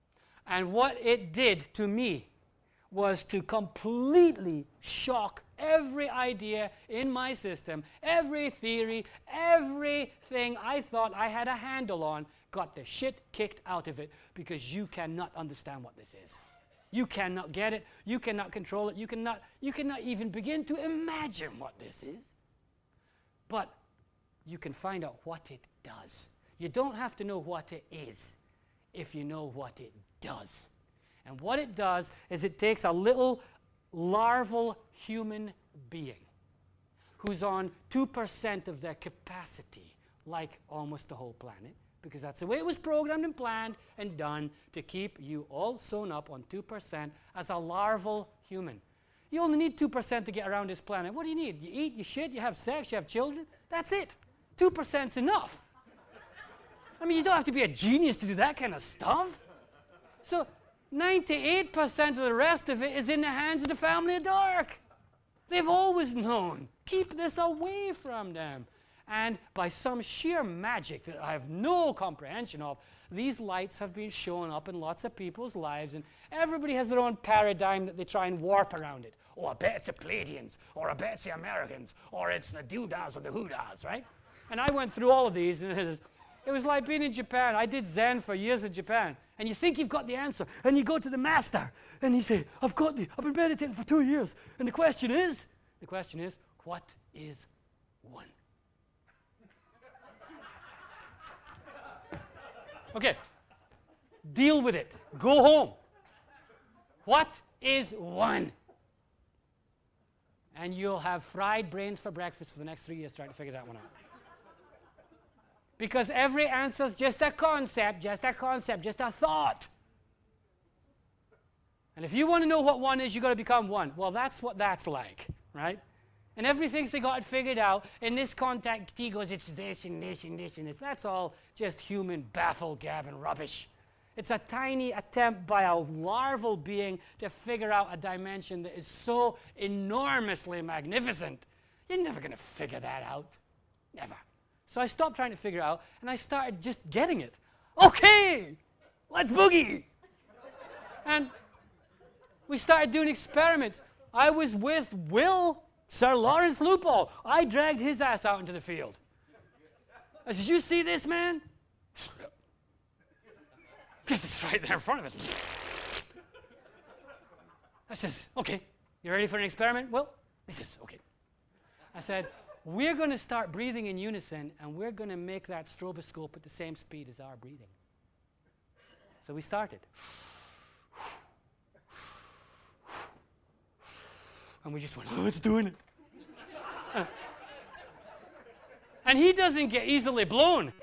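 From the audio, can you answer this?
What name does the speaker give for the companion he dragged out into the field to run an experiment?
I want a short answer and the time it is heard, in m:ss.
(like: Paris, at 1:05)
Sir Lawrence Lupo, at 2:35.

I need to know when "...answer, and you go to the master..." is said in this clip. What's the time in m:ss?
1:30.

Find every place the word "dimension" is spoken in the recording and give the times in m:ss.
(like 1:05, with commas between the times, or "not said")
2:17.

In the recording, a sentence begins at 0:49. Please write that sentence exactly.
You only need 2% to get around this planet.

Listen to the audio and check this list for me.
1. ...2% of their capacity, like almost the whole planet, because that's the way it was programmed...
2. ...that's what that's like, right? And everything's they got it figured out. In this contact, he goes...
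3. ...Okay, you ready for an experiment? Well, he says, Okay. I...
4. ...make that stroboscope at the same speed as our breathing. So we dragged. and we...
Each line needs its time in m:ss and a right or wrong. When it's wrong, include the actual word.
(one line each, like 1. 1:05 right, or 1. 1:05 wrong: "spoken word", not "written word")
1. 0:37 right
2. 2:04 right
3. 2:48 right
4. 2:55 wrong: "started", not "dragged".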